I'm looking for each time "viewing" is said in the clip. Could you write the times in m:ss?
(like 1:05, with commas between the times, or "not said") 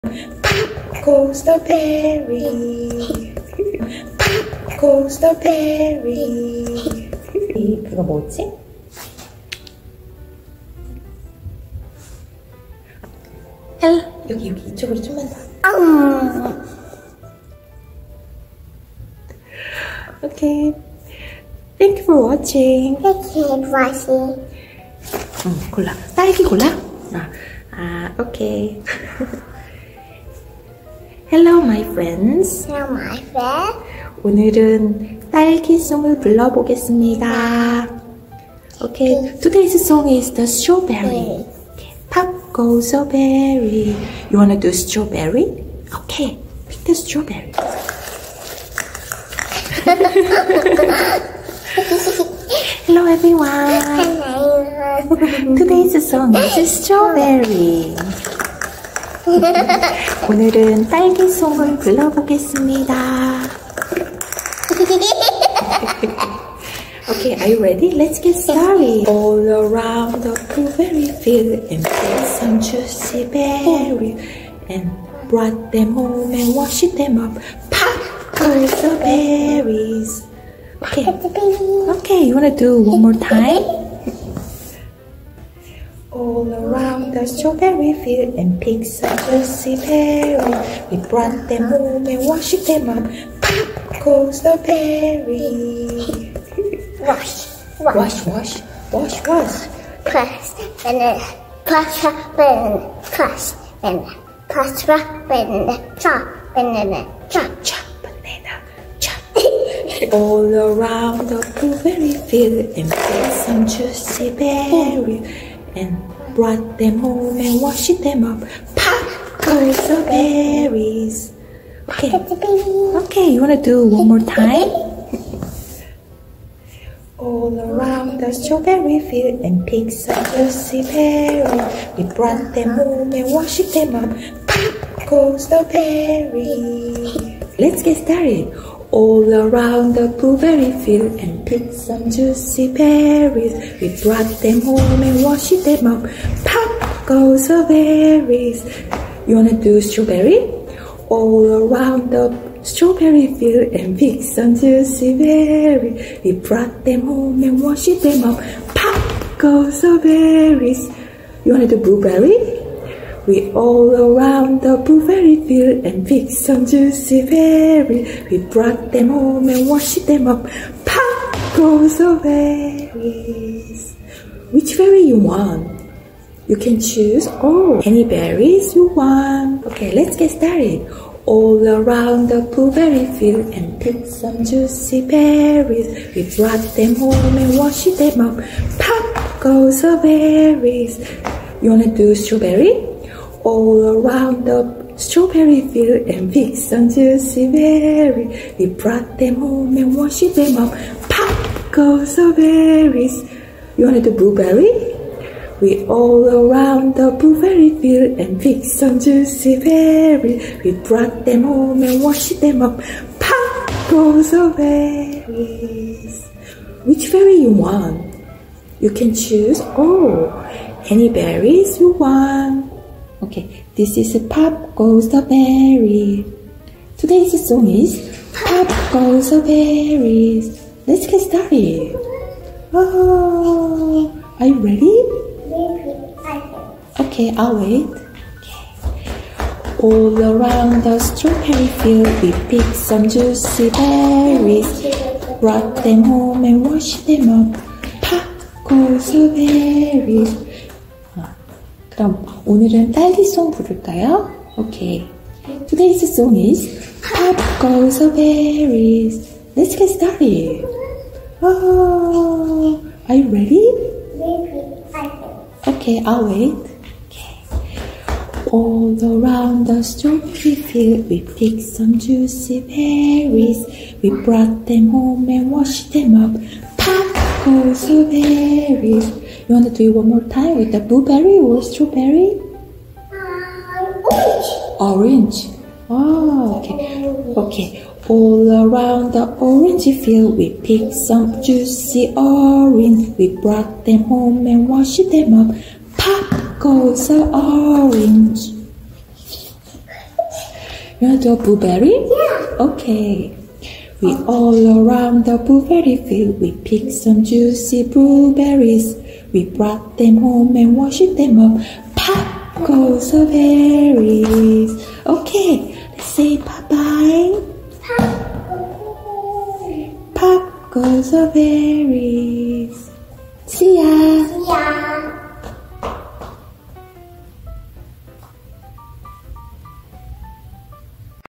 not said.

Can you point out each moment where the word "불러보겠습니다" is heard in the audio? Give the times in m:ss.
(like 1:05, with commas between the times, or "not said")
0:36, 1:01.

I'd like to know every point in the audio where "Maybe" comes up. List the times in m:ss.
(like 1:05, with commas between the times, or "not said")
4:24.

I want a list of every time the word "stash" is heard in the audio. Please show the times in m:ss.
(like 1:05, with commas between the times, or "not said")
not said.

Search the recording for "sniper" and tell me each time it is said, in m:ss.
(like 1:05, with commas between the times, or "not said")
not said.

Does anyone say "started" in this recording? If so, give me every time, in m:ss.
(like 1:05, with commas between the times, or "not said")
1:08, 2:18, 3:00, 3:51, 4:19.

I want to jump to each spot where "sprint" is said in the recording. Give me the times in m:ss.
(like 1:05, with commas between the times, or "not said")
not said.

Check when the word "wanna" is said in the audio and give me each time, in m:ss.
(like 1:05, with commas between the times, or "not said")
0:44, 1:22, 2:03, 2:29, 2:41, 3:11.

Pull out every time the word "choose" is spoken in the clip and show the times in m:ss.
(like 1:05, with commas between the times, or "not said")
2:56, 3:39.